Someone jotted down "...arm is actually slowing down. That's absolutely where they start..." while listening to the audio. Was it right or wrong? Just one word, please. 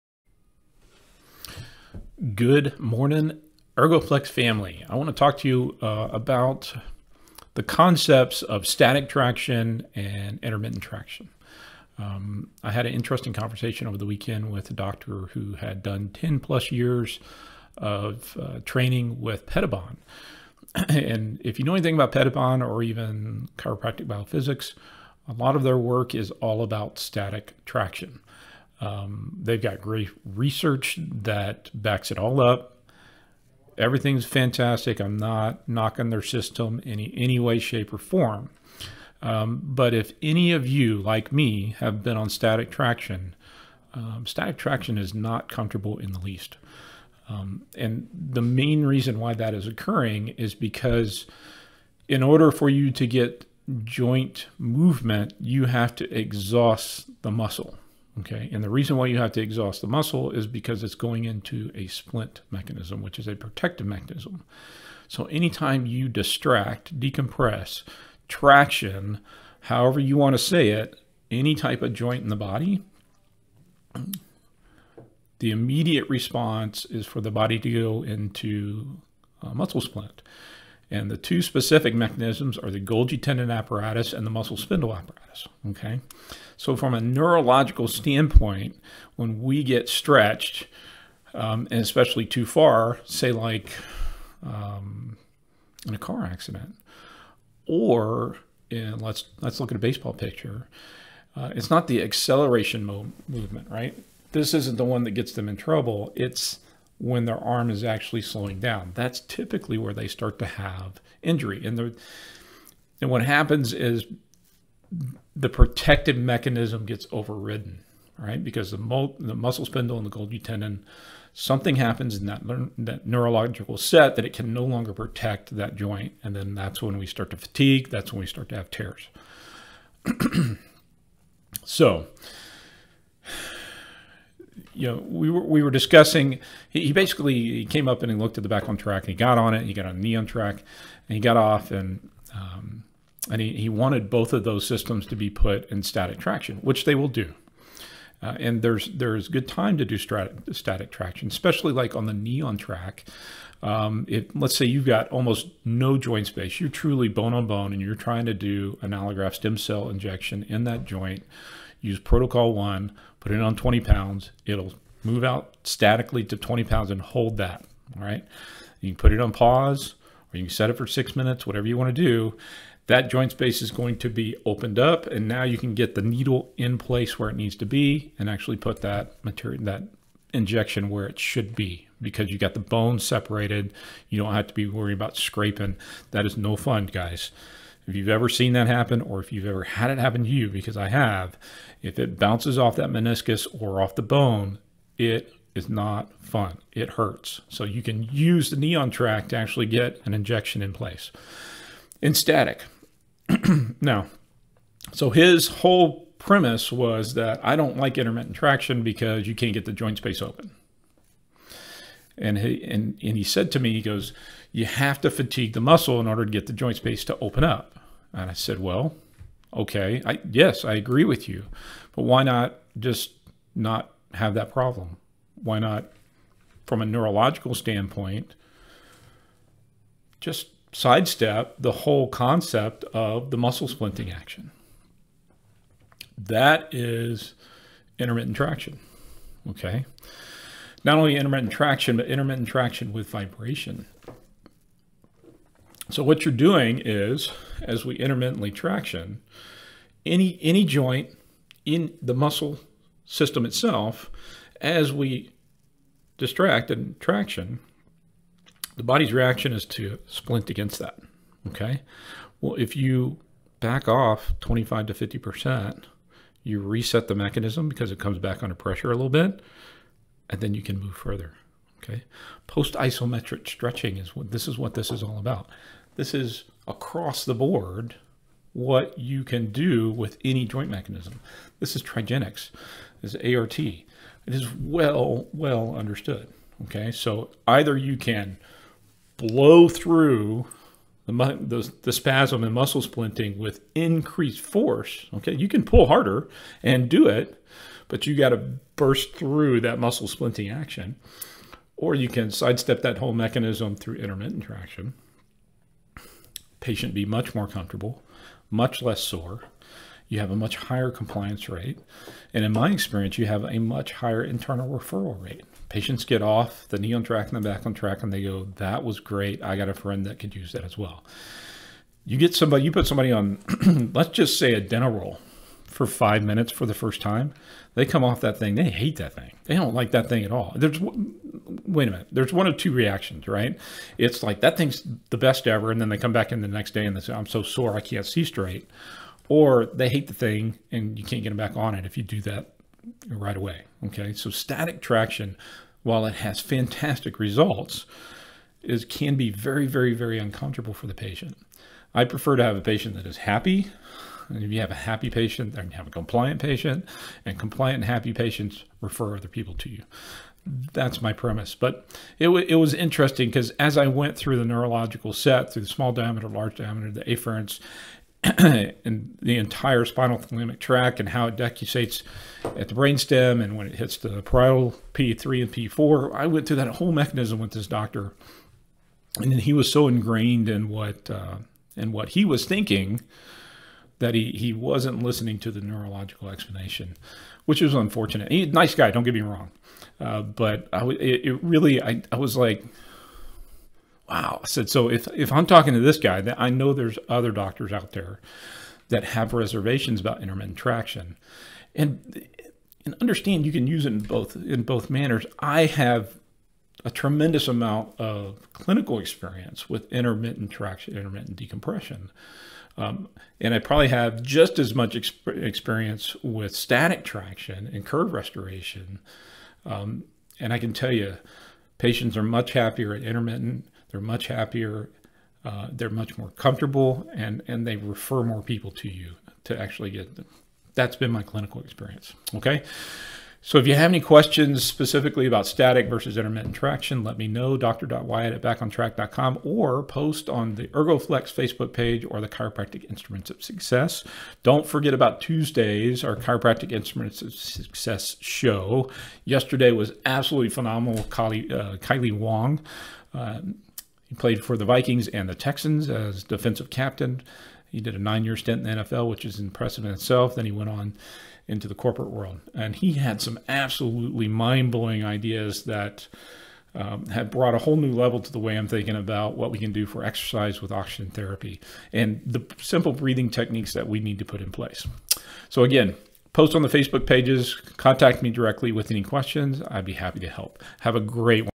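wrong.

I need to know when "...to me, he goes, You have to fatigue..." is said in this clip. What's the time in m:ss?
3:33.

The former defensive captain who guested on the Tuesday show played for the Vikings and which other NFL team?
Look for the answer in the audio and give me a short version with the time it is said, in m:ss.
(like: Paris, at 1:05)
Texans, at 7:35.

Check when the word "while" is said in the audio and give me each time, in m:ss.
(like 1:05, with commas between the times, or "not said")
5:45.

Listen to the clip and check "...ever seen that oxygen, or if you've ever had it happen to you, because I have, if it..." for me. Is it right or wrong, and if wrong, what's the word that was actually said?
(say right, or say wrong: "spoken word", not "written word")
wrong: "happen", not "oxygen".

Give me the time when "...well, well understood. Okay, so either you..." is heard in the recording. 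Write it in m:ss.
4:44.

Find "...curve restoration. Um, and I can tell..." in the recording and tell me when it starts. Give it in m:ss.
6:57.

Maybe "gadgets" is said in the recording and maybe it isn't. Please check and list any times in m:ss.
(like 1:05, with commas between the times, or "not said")
not said.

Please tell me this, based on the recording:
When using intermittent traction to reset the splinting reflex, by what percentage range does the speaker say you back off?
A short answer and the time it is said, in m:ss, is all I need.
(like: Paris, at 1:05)
25 to 50%, at 4:24.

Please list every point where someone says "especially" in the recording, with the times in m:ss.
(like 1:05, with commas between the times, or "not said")
1:31, 2:31.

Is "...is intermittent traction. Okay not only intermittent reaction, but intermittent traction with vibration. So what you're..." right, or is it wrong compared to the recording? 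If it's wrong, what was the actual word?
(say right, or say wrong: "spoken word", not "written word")
wrong: "traction", not "reaction".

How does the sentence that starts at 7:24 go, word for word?
Don't forget about Tuesdays, our Chiropractic Instruments of Success show.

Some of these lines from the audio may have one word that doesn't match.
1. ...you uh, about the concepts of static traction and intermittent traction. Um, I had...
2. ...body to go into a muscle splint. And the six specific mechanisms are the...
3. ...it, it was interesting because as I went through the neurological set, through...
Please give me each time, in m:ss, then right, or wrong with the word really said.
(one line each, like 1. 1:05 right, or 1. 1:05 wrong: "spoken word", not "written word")
1. 0:05 right
2. 1:17 wrong: "two", not "six"
3. 6:02 right.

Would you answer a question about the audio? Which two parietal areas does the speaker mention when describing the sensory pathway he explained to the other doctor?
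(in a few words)
P3 and P4.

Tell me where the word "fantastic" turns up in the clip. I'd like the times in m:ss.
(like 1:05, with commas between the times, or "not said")
0:34, 5:46.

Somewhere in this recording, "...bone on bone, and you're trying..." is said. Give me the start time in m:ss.
2:37.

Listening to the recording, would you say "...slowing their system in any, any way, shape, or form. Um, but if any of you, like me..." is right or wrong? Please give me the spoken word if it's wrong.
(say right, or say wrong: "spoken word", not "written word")
wrong: "knocking", not "slowing".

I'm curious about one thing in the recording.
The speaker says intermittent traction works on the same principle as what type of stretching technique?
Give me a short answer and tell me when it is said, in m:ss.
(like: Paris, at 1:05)
post isometric stretching, at 4:32.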